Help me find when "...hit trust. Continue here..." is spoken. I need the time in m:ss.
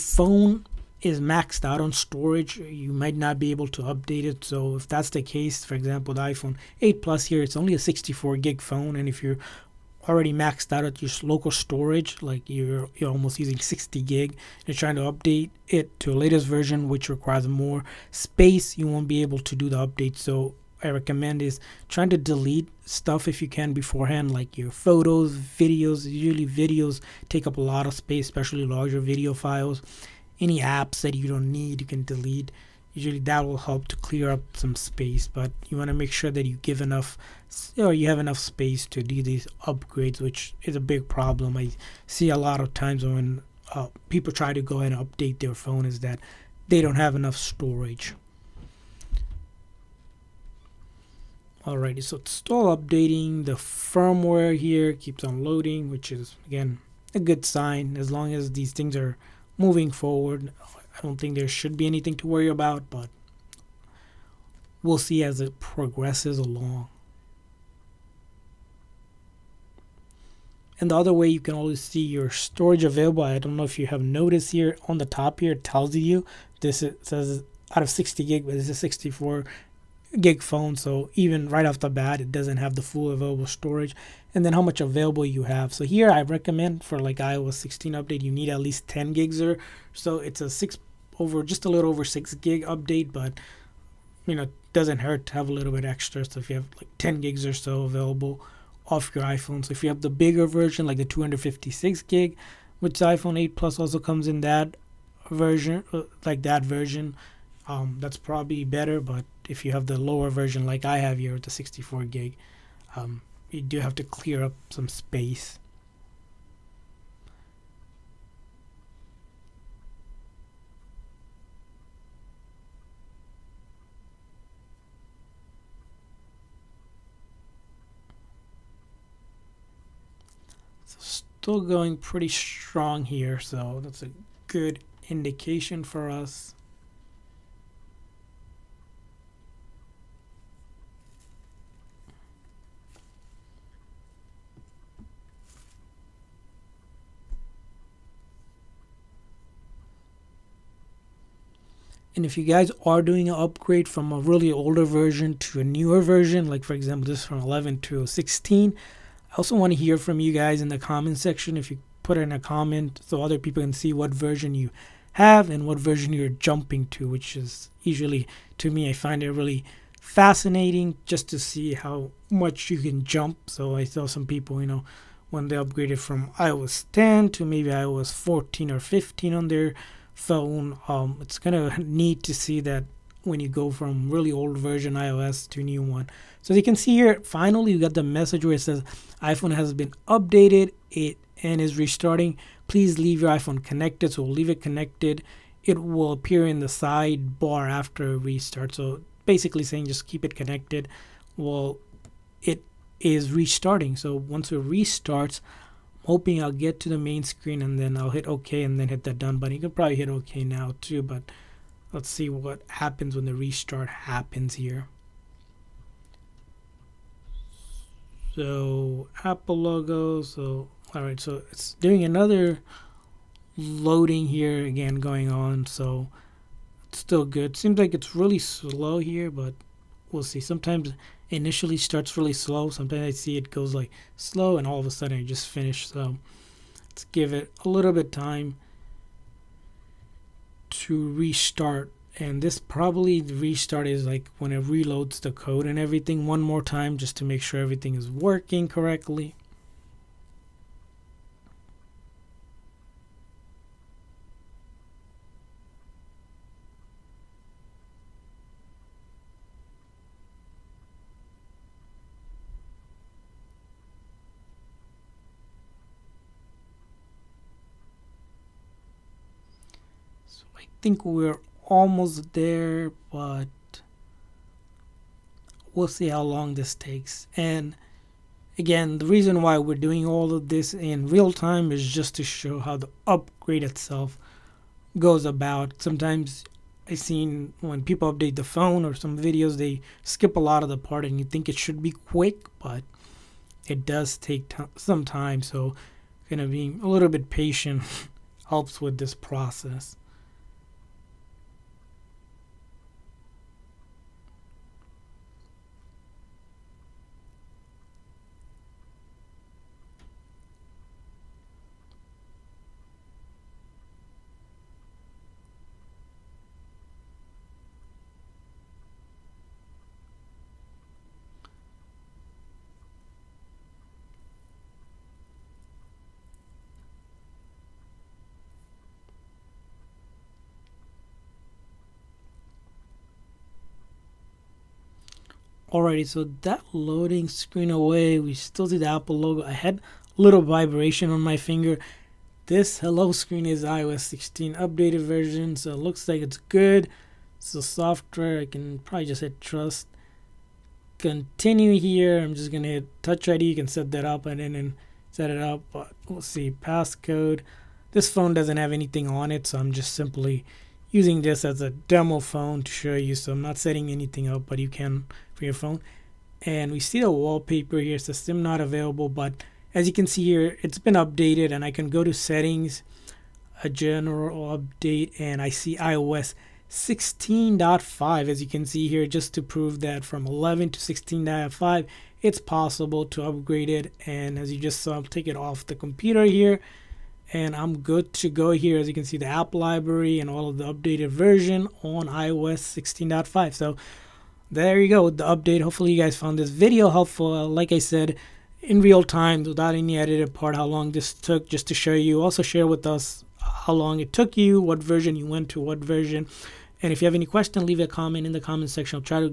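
5:49.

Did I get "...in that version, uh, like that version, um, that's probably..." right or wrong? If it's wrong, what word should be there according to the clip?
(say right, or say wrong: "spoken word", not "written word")
right.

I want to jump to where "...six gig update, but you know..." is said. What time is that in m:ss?
1:32.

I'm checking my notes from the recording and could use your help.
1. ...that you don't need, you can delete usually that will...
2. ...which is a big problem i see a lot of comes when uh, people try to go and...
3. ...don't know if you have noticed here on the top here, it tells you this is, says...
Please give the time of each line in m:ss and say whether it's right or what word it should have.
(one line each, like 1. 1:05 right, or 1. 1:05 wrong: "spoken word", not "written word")
1. 0:31 right
2. 0:40 wrong: "times", not "comes"
3. 1:13 right.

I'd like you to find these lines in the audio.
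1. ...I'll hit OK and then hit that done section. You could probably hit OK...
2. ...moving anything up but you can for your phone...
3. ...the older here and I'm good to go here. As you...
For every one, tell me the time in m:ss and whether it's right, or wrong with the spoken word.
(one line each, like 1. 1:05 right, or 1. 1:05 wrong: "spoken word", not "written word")
1. 3:27 wrong: "button", not "section"
2. 6:03 wrong: "setting", not "moving"
3. 6:25 wrong: "computer", not "older".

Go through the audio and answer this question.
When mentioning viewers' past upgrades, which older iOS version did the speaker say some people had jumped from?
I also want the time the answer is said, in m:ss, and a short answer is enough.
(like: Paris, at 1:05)
iOS 10, at 2:56.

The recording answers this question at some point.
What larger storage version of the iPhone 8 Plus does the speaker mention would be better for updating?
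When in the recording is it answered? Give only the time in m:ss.
1:41.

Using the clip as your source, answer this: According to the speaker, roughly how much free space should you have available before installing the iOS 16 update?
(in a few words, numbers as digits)
10 gigs.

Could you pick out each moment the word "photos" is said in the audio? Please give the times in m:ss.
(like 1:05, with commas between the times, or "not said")
0:24.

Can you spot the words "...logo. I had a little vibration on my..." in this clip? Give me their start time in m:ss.
5:39.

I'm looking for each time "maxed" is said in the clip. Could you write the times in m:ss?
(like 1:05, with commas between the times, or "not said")
0:01, 0:10.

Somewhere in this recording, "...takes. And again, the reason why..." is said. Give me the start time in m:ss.
4:36.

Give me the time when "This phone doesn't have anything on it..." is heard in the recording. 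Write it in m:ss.
5:57.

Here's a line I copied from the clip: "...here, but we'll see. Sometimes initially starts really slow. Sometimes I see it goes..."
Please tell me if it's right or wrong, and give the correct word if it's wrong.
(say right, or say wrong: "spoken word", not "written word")
right.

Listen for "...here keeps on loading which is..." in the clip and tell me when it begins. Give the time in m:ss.
0:54.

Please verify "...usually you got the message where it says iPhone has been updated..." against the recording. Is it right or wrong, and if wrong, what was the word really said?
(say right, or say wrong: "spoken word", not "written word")
wrong: "finally", not "usually".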